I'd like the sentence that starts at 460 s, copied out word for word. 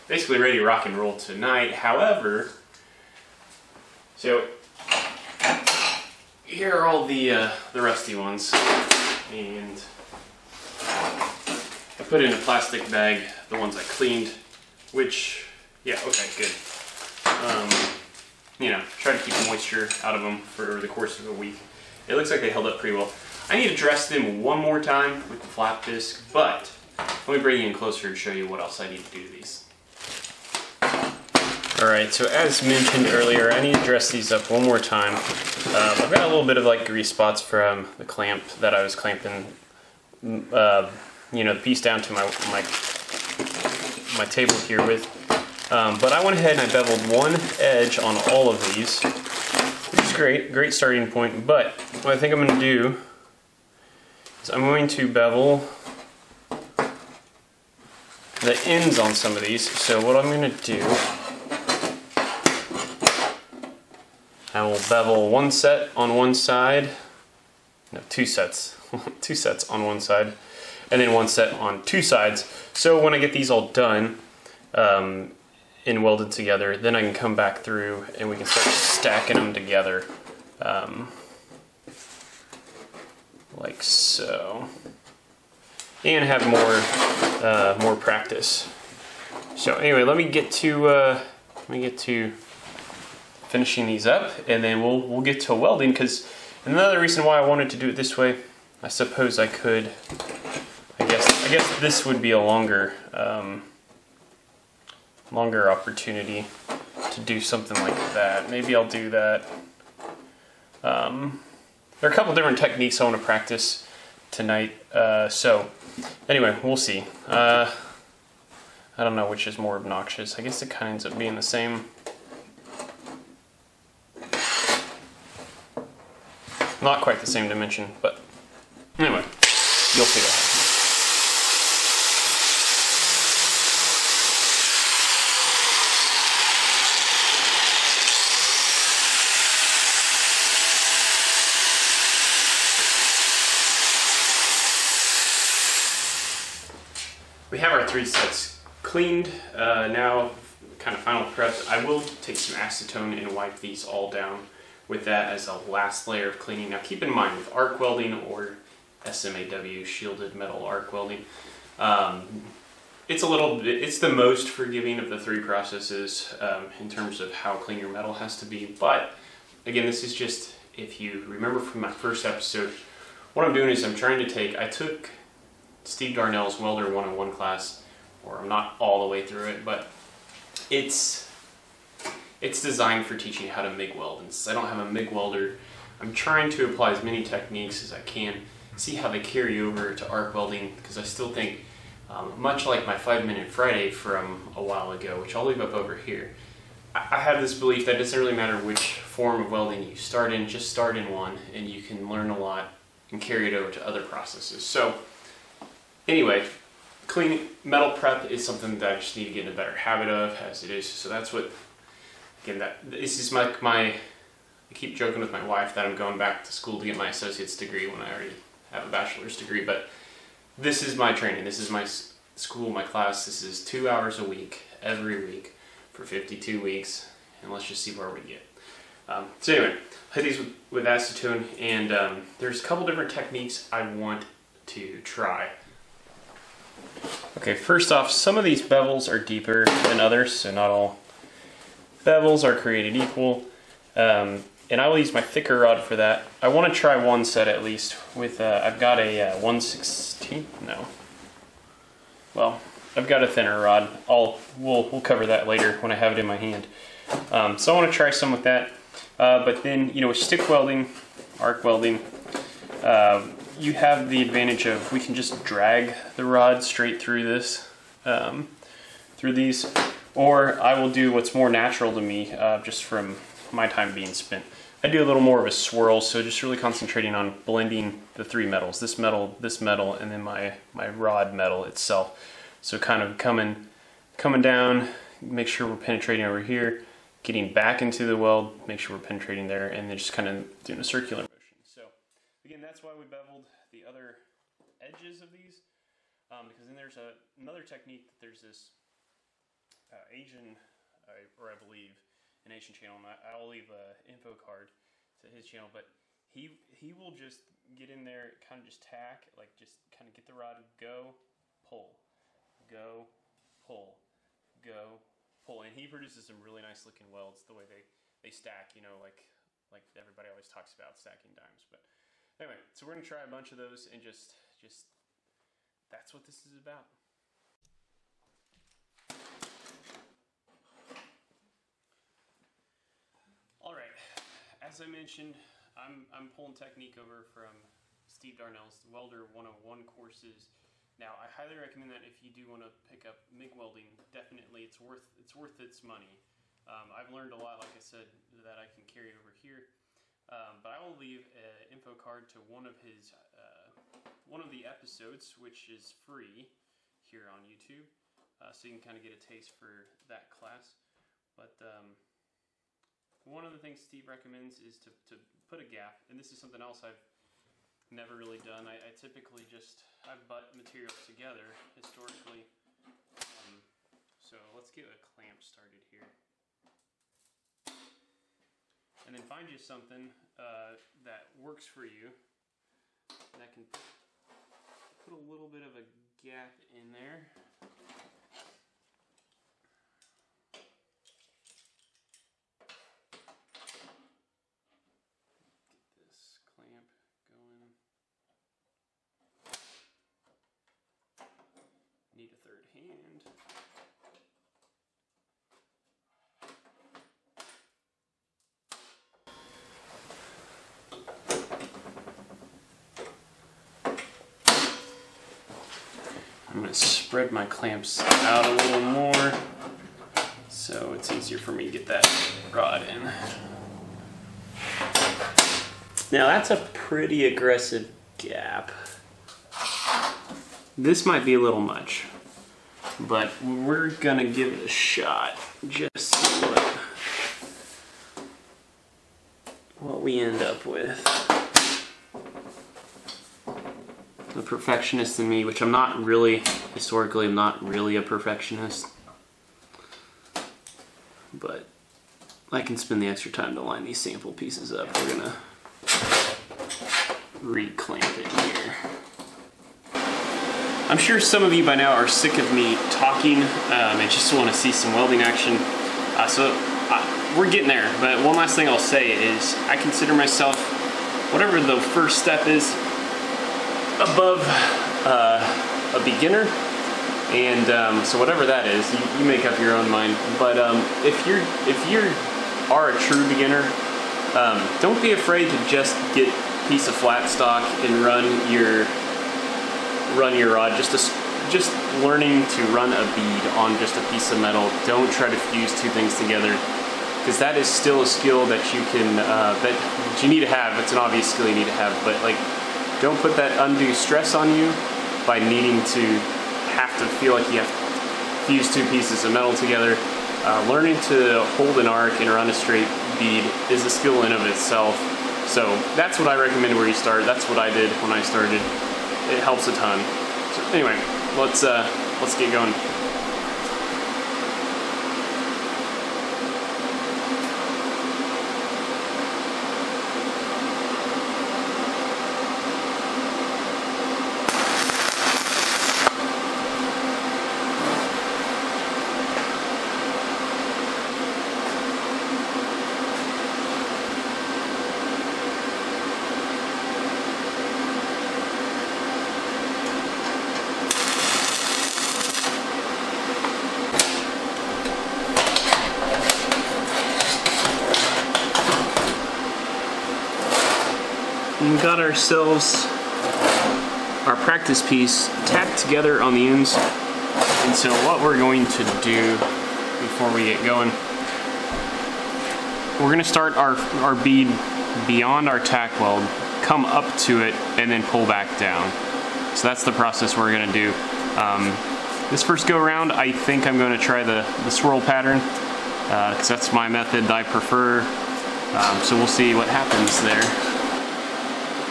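I'm sure some of you by now are sick of me talking um, and just want to see some welding action.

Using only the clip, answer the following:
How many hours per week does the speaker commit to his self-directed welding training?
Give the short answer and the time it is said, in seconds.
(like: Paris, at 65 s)
2, at 223 s.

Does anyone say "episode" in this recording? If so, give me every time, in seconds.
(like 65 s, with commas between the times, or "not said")
172 s, 354 s.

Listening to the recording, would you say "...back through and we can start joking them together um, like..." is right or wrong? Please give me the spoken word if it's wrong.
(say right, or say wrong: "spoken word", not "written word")
wrong: "stacking", not "joking".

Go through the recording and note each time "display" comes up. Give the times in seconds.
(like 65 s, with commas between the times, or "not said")
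not said.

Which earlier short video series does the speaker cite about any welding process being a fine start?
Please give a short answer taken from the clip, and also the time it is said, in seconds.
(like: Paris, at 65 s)
5 Minute Friday, at 192 s.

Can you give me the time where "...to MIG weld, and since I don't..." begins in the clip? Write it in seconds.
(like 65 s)
183 s.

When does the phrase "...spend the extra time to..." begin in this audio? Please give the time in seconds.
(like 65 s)
452 s.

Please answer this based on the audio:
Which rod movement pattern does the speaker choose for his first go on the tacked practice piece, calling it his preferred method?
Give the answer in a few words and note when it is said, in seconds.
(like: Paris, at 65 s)
swirl pattern, at 584 s.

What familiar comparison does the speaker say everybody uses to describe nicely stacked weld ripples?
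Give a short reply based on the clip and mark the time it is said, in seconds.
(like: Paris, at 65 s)
stacking dimes, at 320 s.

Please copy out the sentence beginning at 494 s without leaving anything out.
Don't try to fuse two things together because that is still a skill that you can uh, that you need to have.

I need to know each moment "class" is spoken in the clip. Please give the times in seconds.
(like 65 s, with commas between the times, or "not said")
177 s, 222 s, 360 s.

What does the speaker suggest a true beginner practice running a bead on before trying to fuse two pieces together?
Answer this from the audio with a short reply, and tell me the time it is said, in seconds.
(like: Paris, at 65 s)
flat stock, at 486 s.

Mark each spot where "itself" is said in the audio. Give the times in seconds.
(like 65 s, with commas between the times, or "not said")
281 s, 514 s.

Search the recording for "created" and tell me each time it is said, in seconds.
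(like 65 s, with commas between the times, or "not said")
242 s.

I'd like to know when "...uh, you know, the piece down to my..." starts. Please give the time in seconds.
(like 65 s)
40 s.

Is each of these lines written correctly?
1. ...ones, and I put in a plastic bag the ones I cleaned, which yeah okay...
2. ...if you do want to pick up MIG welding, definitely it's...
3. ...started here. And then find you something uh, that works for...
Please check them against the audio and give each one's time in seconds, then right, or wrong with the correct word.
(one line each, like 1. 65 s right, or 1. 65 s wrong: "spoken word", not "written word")
1. 8 s right
2. 342 s right
3. 375 s right.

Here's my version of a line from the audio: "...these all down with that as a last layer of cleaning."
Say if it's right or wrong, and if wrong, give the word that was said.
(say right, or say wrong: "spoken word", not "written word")
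right.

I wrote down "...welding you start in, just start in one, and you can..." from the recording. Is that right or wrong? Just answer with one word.
right.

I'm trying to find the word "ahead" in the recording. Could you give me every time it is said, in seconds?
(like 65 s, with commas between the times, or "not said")
46 s.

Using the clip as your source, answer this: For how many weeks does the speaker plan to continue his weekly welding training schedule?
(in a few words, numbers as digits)
52.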